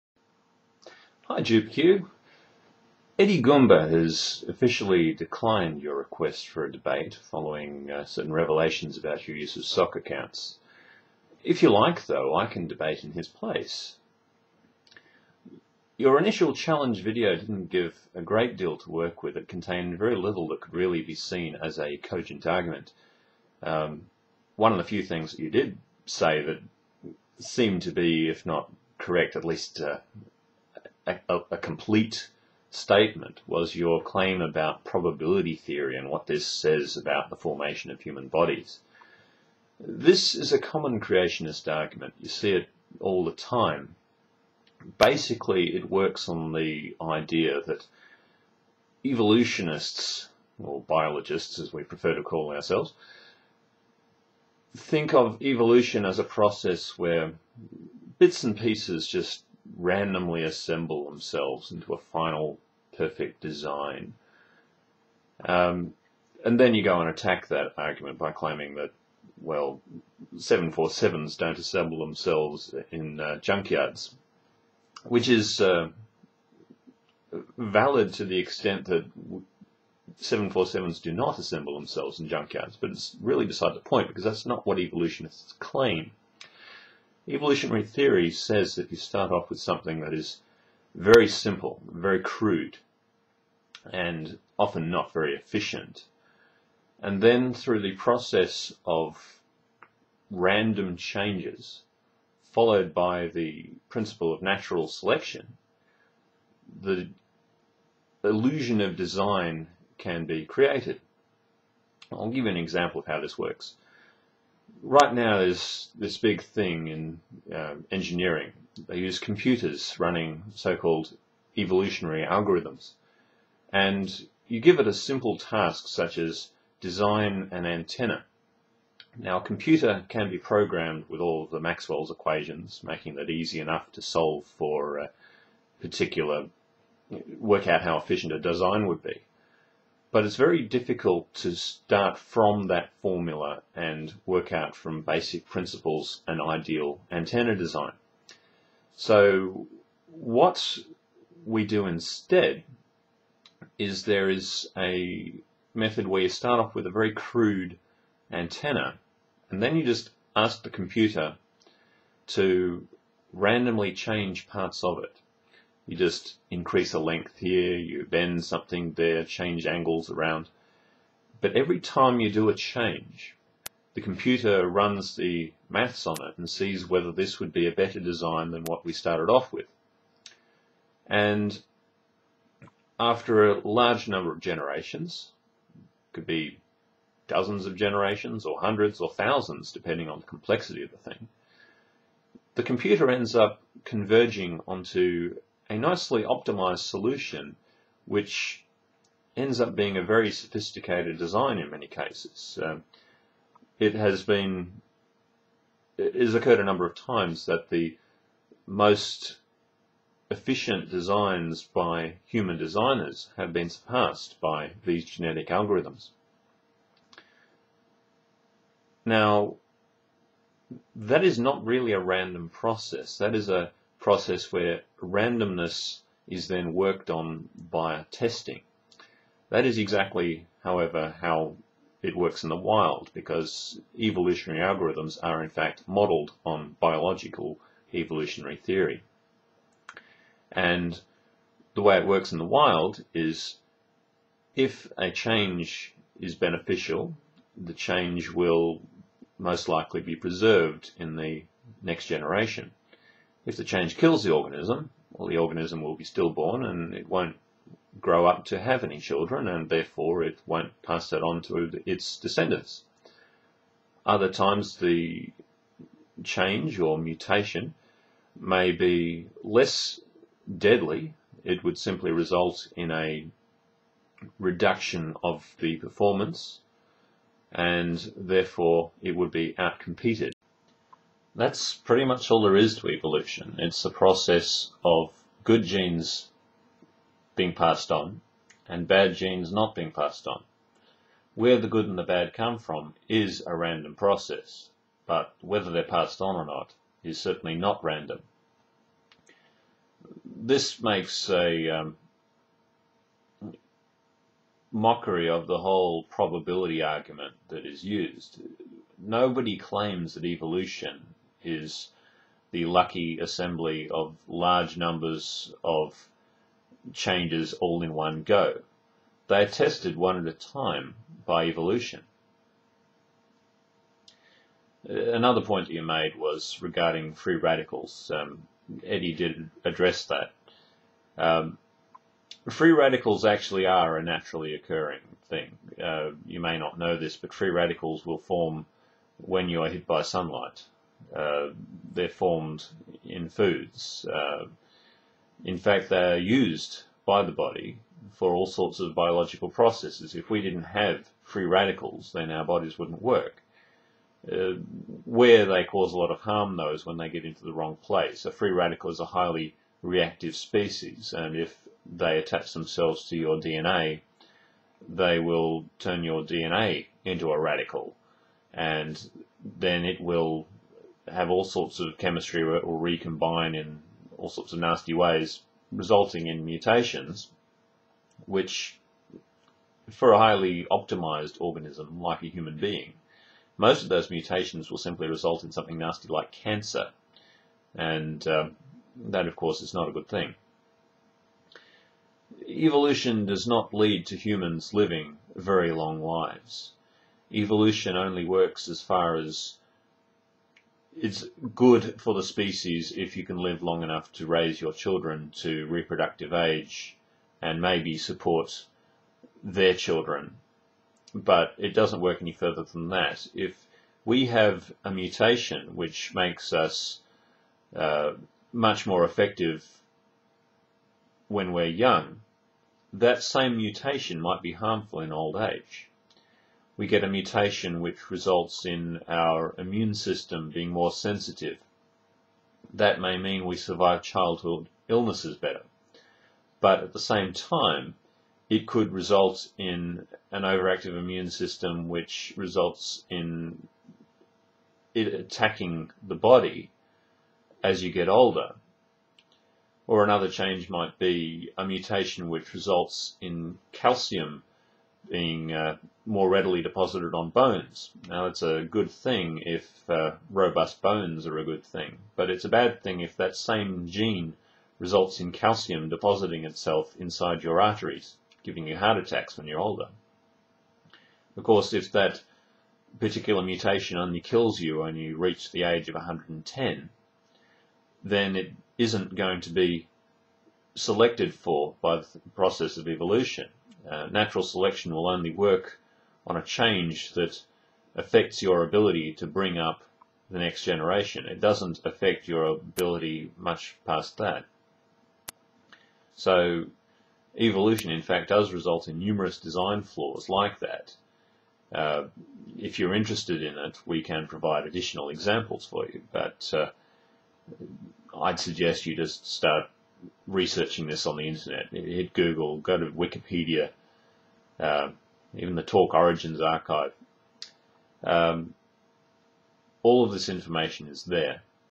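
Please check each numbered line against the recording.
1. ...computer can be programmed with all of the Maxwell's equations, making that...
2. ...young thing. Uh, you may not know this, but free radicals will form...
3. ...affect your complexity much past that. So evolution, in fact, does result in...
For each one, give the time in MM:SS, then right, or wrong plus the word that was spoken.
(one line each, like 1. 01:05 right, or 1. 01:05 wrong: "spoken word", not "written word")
1. 02:09 right
2. 05:34 wrong: "occurring", not "young"
3. 08:11 wrong: "ability", not "complexity".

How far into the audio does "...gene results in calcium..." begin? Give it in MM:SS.
07:43.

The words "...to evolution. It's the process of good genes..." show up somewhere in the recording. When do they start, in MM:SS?
04:42.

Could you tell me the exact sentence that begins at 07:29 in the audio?
Or another change might be a mutation which results in calcium being uh, more readily deposited on bones.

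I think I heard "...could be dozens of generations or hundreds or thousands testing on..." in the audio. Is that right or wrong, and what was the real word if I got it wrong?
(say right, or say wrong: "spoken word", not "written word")
wrong: "depending", not "testing".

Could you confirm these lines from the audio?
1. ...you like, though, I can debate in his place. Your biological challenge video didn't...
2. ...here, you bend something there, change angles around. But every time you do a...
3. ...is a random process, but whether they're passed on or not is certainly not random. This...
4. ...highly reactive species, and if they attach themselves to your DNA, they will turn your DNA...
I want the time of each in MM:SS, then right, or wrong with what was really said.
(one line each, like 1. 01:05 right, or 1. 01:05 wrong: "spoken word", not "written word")
1. 00:11 wrong: "initial", not "biological"
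2. 02:47 right
3. 04:53 right
4. 05:59 right.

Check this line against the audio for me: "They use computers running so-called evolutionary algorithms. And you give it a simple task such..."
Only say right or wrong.
right.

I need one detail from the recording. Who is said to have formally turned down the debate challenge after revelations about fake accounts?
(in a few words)
Eddie Goombah.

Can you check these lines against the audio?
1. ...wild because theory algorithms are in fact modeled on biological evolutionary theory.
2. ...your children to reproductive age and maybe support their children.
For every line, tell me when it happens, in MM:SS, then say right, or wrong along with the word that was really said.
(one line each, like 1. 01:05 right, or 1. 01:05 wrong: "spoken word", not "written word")
1. 03:52 wrong: "evolutionary", not "theory"
2. 06:44 right.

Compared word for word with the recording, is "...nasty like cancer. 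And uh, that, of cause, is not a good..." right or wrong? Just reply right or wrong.
wrong.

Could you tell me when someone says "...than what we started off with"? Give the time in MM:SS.
02:58.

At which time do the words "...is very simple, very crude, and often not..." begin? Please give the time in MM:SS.
01:30.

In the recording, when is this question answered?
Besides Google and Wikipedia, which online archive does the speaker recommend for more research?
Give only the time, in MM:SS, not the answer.
08:35.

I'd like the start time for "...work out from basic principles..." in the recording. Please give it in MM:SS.
02:24.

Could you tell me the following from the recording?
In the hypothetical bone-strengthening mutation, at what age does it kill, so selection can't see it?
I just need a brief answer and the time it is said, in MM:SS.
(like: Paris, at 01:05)
110, at 07:55.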